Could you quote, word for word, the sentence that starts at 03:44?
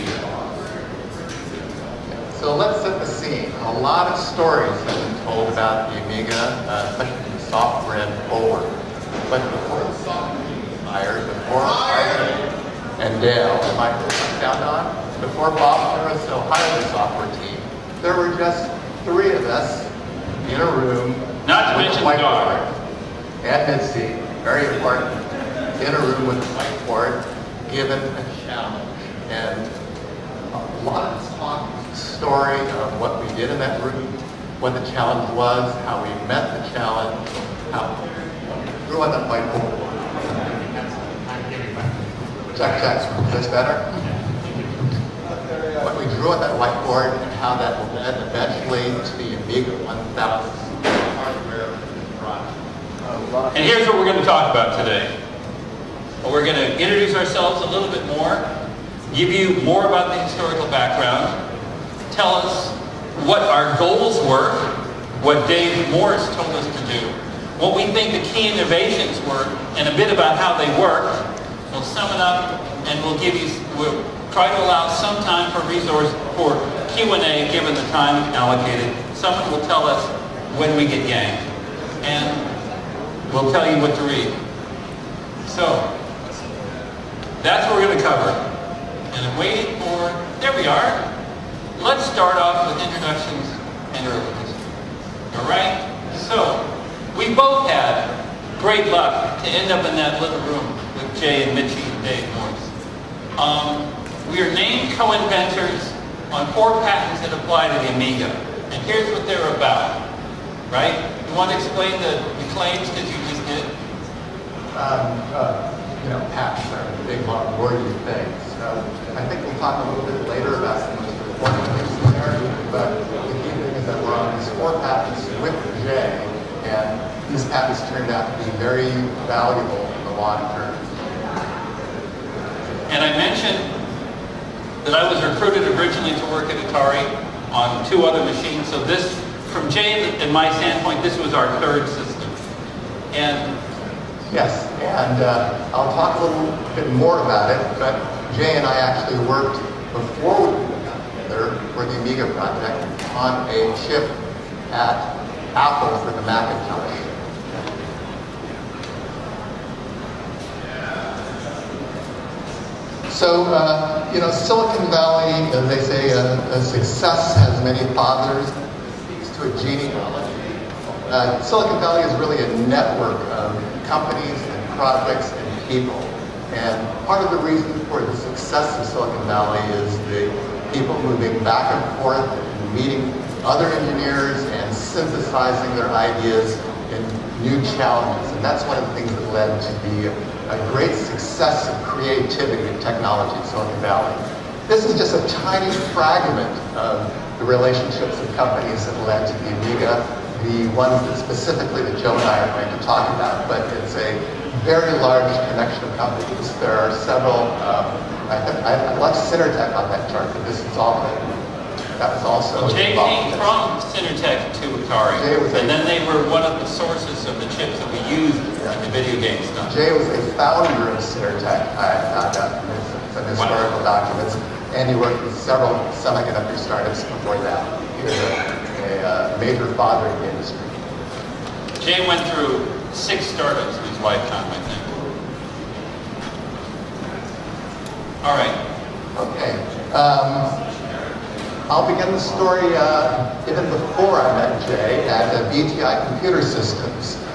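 documents, and he worked with several semiconductor startups before that.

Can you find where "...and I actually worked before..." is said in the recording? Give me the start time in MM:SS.
02:28.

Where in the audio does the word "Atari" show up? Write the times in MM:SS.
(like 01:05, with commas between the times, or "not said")
02:16, 03:34.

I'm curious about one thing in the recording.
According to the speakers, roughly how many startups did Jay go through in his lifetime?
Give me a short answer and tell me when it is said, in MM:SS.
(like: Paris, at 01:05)
6, at 03:52.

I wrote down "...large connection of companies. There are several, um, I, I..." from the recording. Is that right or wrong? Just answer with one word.
right.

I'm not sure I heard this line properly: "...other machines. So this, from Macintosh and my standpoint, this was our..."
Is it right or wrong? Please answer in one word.
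wrong.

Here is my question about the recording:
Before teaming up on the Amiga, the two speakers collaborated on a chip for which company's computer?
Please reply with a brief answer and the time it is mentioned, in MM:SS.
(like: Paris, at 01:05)
Apple, at 02:34.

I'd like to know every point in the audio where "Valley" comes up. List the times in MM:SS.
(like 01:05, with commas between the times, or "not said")
02:44, 02:51, 02:59, 03:13.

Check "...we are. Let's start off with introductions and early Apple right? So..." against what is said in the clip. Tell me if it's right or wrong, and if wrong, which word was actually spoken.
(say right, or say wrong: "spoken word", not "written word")
wrong: "All", not "Apple".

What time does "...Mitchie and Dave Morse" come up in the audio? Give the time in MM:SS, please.
01:41.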